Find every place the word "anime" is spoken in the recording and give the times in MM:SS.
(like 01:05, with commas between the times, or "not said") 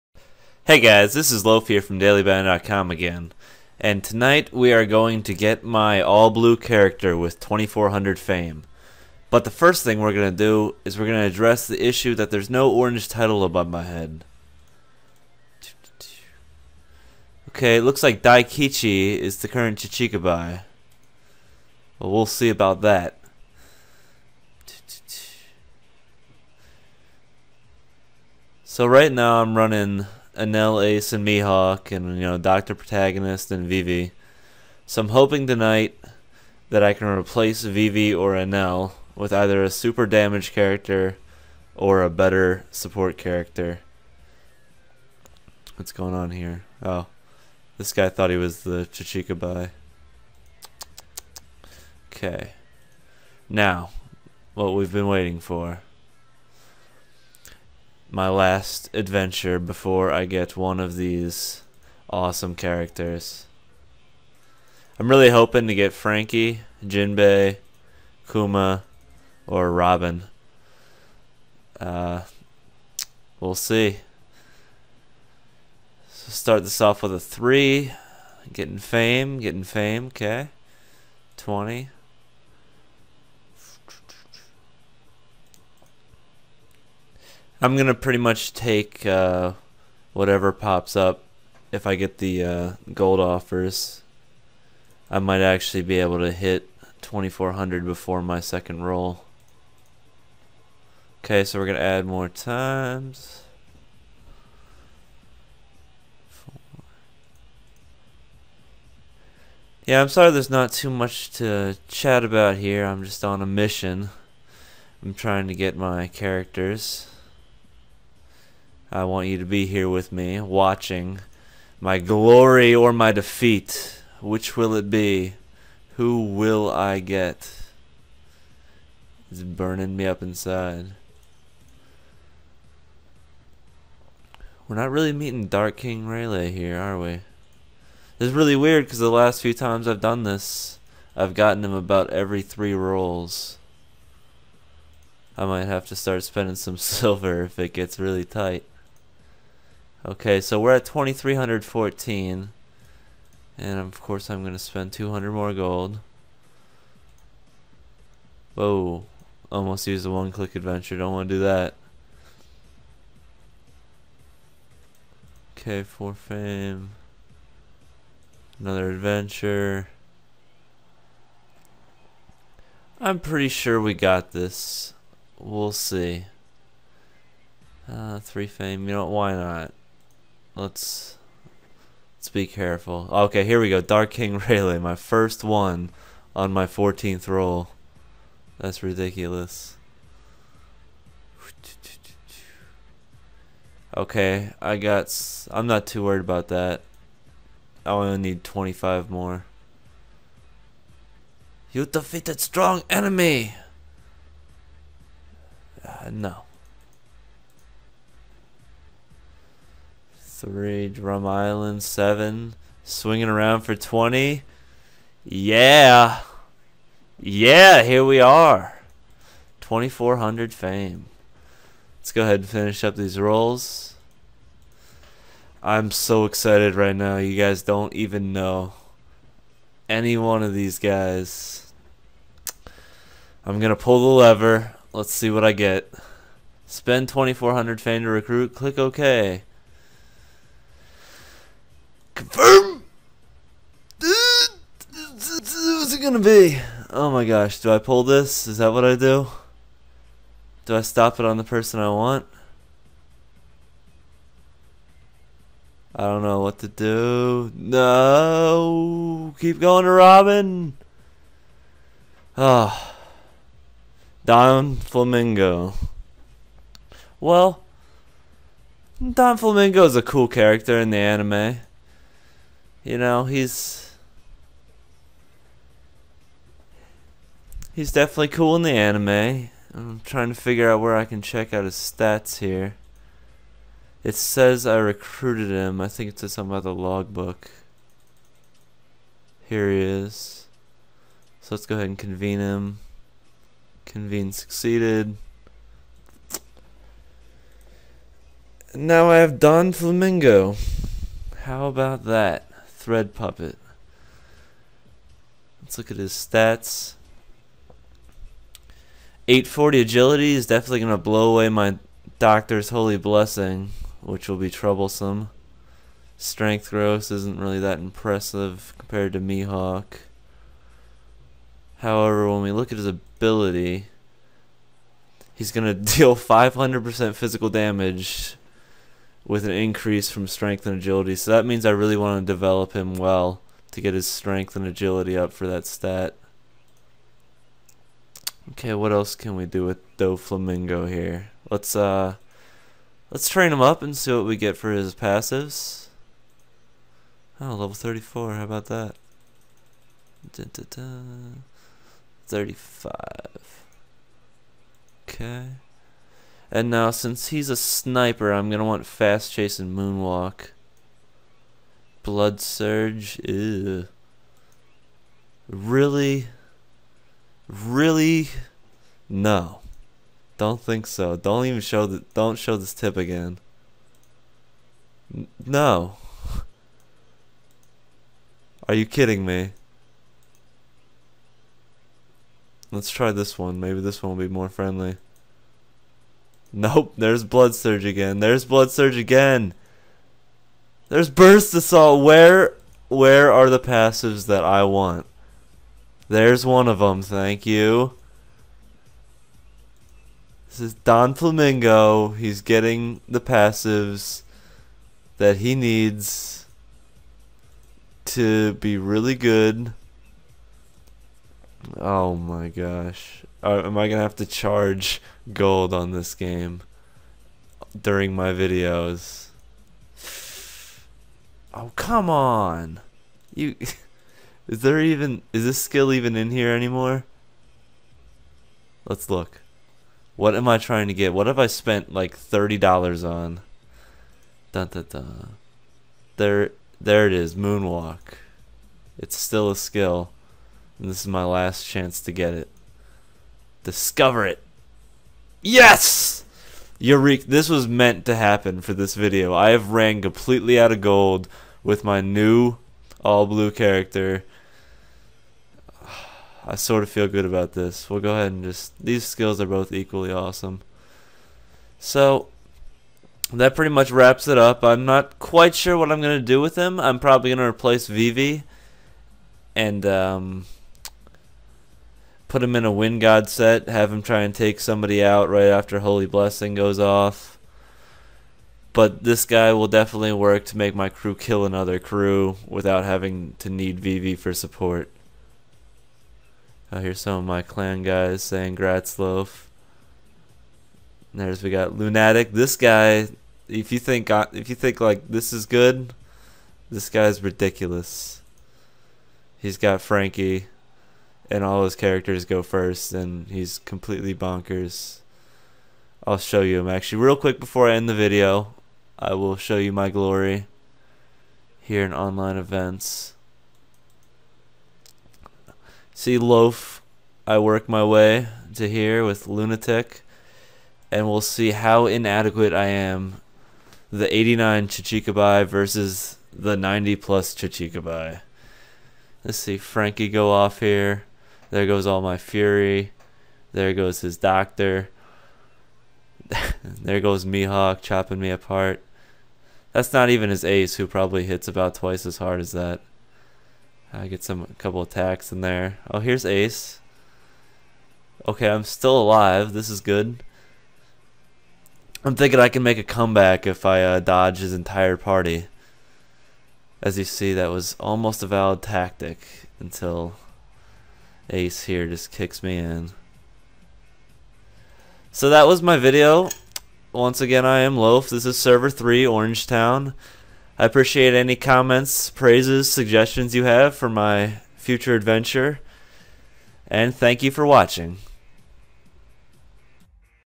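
04:30, 04:38.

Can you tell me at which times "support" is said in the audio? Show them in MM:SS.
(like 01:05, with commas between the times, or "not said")
00:42, 08:04.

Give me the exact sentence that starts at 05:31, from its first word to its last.
So that means I really want to develop him well to get his strength and agility up for that stat.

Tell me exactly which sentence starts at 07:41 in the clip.
So, that pretty much wraps it up.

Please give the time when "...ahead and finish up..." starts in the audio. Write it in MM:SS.
03:42.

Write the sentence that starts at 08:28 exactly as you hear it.
I will show you my glory here in online events.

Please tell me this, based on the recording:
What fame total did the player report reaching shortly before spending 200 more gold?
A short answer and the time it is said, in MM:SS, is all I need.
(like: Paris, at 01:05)
2314, at 02:30.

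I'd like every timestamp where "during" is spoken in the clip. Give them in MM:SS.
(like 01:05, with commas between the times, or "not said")
06:57.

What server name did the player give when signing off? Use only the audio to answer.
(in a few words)
Orangetown.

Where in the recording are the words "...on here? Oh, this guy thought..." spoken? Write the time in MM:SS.
00:46.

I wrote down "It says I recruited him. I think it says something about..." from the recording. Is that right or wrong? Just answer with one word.
right.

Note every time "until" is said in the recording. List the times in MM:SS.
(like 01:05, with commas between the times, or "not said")
09:19.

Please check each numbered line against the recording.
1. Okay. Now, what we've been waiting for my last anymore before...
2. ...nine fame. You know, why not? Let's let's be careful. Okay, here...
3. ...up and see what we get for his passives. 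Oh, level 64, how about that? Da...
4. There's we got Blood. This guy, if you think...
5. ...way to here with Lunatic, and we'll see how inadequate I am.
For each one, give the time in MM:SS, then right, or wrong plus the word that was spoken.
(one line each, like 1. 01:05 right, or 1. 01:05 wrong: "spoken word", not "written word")
1. 00:52 wrong: "adventure", not "anymore"
2. 02:58 wrong: "three", not "nine"
3. 05:43 wrong: "34", not "64"
4. 08:11 wrong: "Lunatic", not "Blood"
5. 08:37 right.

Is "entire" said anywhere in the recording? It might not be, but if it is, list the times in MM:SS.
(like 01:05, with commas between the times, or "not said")
09:14.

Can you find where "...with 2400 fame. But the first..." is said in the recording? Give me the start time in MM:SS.
00:07.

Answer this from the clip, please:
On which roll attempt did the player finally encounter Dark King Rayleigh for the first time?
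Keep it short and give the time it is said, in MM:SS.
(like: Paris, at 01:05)
14th, at 03:06.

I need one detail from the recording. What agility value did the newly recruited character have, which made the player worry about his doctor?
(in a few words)
840.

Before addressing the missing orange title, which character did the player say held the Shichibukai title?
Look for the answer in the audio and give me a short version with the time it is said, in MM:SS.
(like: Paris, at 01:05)
Daikichi, at 00:18.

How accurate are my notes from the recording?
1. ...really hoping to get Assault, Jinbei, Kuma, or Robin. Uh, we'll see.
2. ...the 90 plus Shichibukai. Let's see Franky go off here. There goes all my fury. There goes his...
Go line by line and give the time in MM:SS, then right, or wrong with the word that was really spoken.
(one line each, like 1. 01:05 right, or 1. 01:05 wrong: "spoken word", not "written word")
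1. 01:05 wrong: "Franky", not "Assault"
2. 08:46 right.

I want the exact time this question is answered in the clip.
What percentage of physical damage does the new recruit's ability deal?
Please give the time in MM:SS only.
05:26.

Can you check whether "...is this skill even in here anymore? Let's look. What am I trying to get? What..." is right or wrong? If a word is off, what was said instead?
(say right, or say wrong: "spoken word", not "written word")
right.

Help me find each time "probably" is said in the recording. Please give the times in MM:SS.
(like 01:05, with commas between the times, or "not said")
07:46, 09:00.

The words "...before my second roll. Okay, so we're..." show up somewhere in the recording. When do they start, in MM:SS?
01:37.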